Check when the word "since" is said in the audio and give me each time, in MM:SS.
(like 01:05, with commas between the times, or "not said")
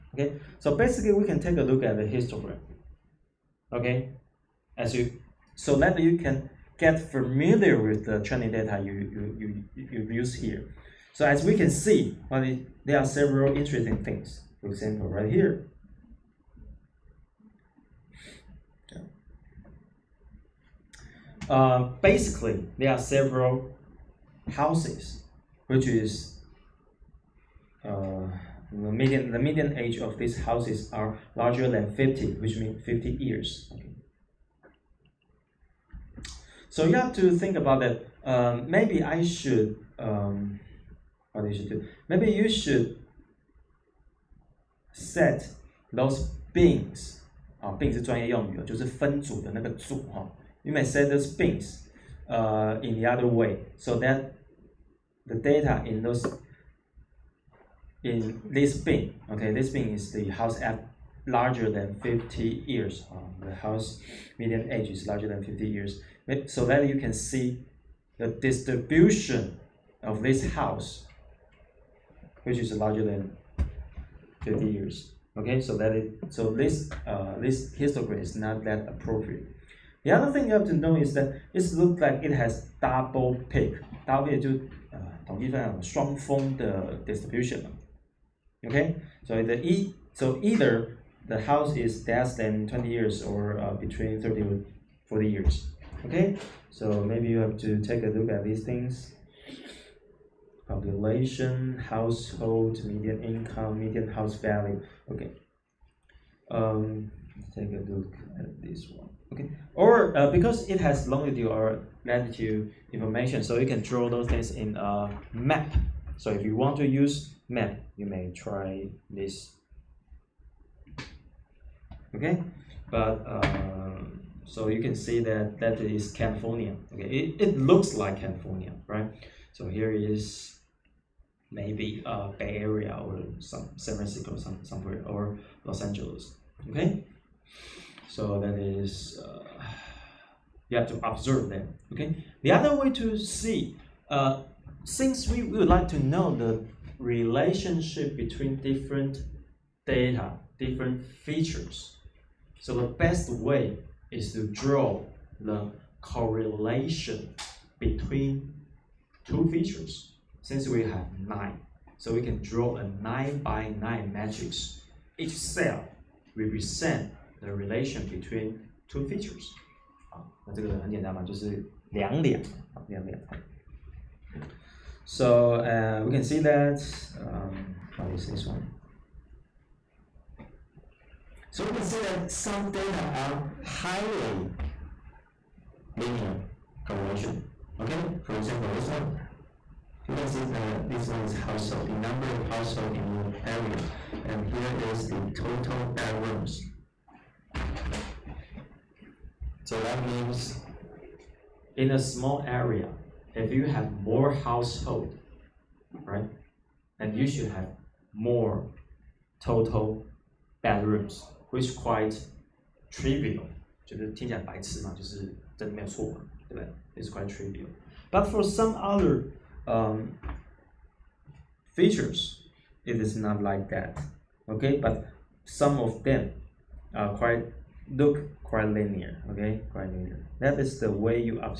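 02:24, 02:40.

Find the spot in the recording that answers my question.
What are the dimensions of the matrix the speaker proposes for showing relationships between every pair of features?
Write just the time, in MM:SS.
02:43.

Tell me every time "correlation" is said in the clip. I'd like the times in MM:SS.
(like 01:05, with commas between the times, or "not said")
02:36, 03:06.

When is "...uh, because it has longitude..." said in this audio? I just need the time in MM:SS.
01:50.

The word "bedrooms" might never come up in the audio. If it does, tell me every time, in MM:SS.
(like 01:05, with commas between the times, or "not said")
03:15, 03:30.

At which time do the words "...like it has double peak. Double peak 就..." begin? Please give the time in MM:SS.
01:22.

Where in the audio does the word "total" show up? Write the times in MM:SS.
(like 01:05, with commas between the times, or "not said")
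03:15, 03:29.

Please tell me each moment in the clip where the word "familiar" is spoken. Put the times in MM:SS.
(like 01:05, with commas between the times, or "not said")
00:06.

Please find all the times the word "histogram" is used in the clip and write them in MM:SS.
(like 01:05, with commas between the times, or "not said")
00:02, 01:17.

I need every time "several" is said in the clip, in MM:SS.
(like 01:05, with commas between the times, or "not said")
00:13, 00:22.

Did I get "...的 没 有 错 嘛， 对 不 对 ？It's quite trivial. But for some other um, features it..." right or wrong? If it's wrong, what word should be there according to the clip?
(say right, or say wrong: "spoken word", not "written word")
right.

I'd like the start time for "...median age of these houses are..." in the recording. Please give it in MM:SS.
00:29.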